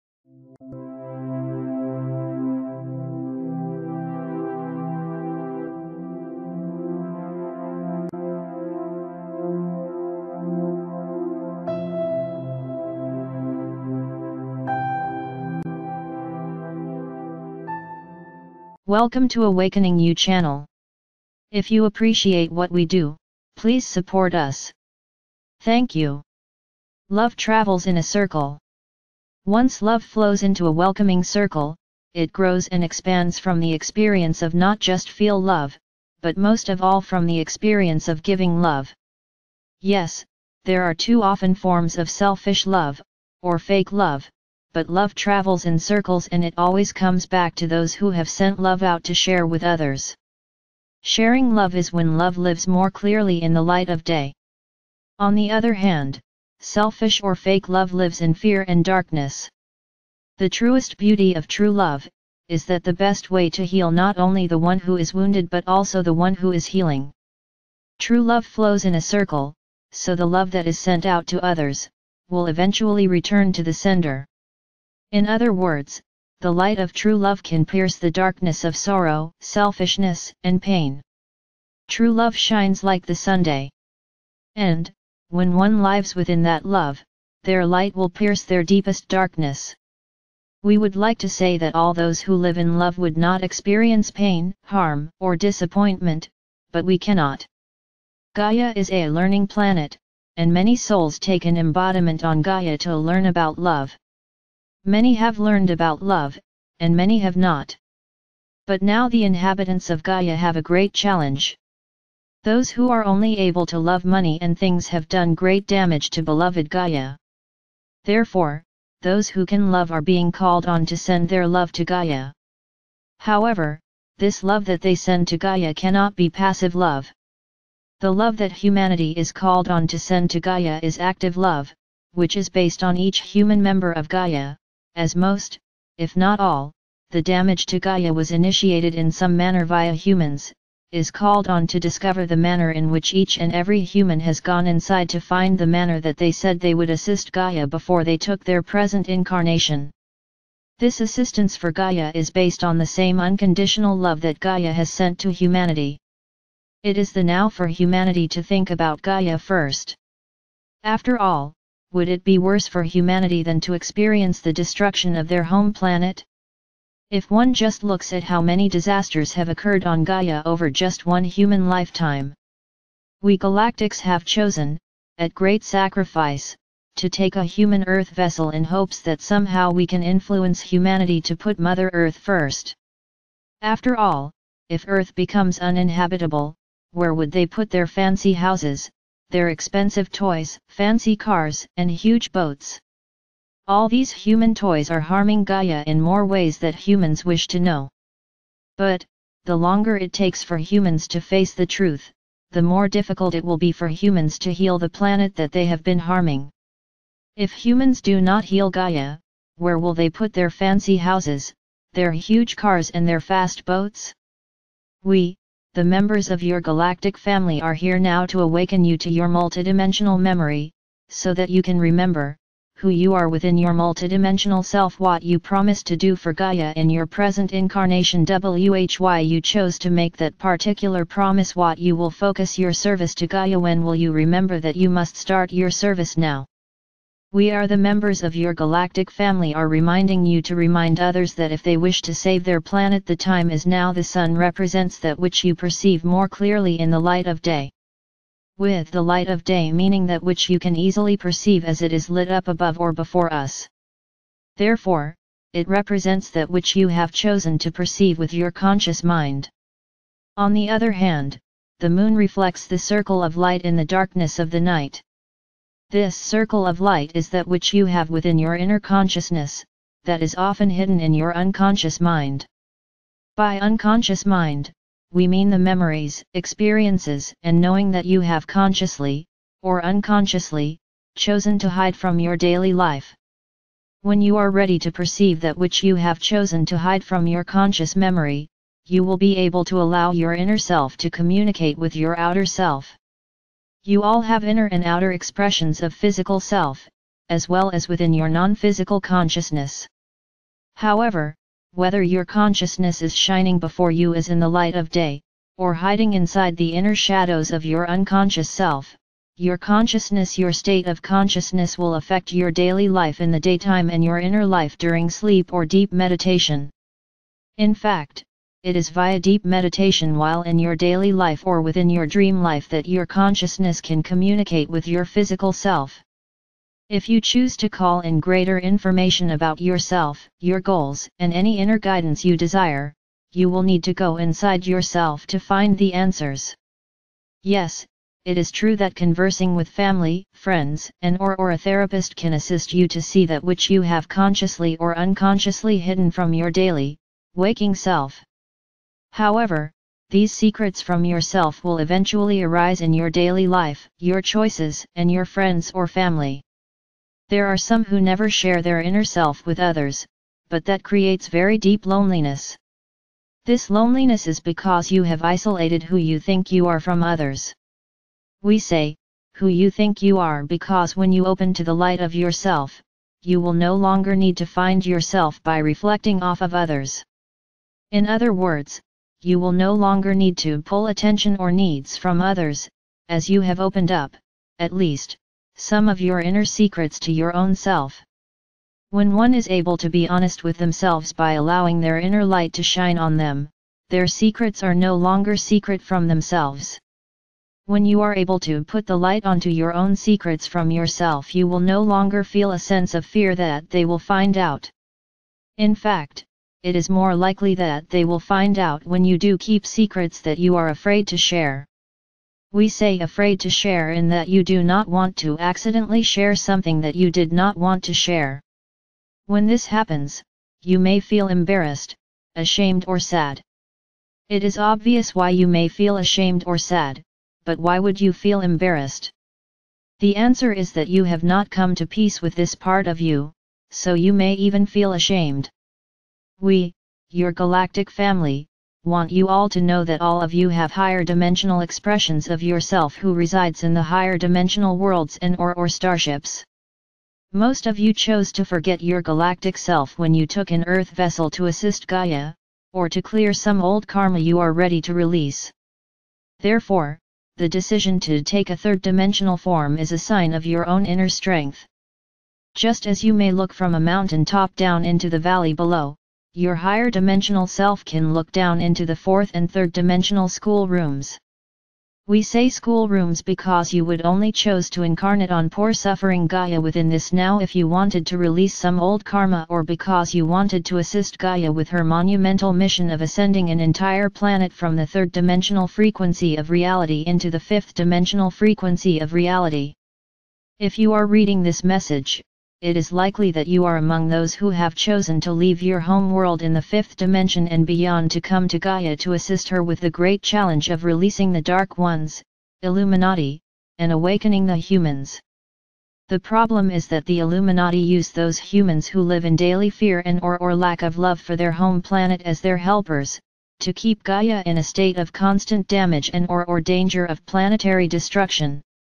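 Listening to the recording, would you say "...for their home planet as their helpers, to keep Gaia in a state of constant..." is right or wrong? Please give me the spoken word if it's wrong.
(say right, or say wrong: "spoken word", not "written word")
right.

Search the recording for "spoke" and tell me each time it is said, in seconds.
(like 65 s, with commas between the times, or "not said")
not said.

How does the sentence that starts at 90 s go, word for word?
We would like to say that all those who live in love would not experience pain, harm, or disappointment, but we cannot.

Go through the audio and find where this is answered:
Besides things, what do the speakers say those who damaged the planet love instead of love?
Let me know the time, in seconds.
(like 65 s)
113 s.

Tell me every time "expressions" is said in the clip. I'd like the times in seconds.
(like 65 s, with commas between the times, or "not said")
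295 s, 441 s.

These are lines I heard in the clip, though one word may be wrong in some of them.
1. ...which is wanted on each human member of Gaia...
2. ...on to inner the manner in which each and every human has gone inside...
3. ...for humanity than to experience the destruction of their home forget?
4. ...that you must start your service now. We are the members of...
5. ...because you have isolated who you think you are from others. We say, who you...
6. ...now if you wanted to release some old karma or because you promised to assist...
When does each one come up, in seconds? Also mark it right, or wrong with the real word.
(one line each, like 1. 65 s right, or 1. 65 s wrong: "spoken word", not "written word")
1. 132 s wrong: "based", not "wanted"
2. 141 s wrong: "discover", not "inner"
3. 162 s wrong: "planet", not "forget"
4. 234 s right
5. 364 s right
6. 477 s wrong: "wanted", not "promised".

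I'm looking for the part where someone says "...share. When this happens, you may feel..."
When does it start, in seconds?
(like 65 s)
417 s.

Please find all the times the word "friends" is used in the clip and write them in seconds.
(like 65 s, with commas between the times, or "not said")
340 s, 355 s.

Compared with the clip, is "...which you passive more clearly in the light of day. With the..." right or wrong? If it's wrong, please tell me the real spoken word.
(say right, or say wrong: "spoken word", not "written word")
wrong: "perceive", not "passive".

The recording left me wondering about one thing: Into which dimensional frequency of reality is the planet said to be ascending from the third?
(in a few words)
fifth dimensional.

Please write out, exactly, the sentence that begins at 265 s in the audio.
This circle of light is that which you have within your inner consciousness, that is often hidden in your unconscious mind.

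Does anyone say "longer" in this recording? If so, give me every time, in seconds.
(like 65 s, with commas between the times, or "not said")
199 s, 373 s, 379 s, 394 s, 401 s.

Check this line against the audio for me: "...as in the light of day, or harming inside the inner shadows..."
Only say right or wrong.
wrong.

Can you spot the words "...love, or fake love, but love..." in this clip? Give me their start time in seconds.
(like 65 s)
42 s.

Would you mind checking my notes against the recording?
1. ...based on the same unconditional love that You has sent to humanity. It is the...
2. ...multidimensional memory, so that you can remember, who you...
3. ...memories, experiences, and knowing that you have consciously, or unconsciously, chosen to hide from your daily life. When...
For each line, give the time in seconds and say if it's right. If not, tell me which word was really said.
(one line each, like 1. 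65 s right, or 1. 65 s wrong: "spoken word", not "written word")
1. 152 s wrong: "Gaia", not "You"
2. 219 s right
3. 275 s right.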